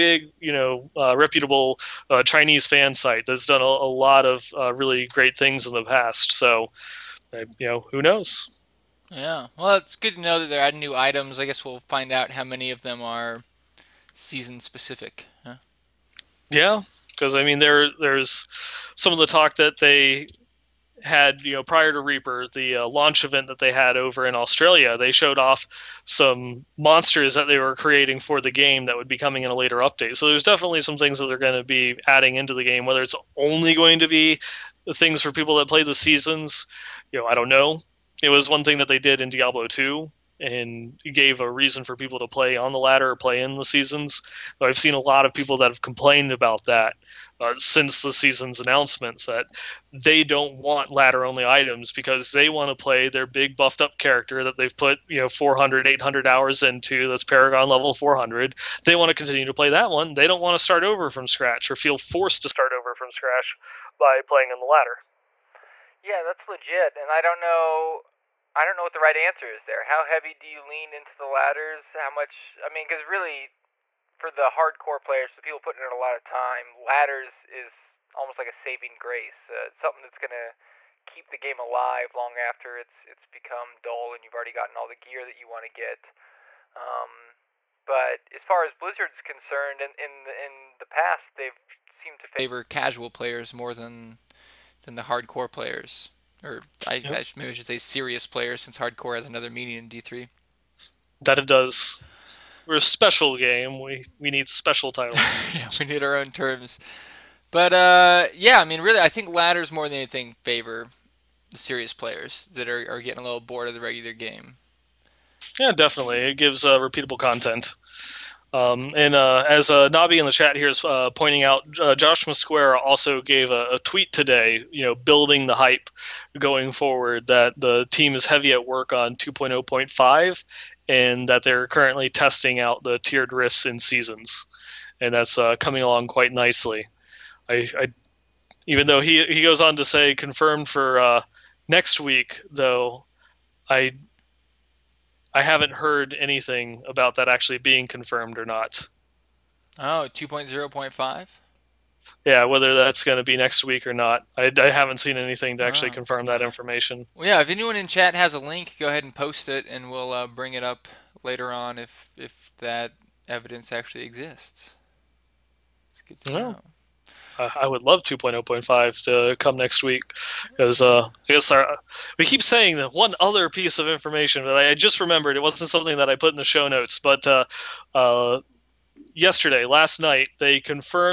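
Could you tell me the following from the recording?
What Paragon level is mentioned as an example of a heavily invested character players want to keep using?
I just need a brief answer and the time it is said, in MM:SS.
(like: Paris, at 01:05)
400, at 00:57.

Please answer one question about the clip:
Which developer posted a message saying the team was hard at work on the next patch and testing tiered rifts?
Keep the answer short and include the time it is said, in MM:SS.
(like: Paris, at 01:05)
Josh Mosqueira, at 02:01.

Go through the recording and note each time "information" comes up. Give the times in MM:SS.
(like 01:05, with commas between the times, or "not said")
02:36, 02:53.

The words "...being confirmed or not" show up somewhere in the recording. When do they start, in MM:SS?
02:27.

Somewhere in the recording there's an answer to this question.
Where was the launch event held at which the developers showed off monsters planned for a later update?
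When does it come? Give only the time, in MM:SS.
00:24.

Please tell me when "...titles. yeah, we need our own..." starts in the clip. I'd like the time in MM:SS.
01:44.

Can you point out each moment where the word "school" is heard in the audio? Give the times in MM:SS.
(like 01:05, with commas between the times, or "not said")
not said.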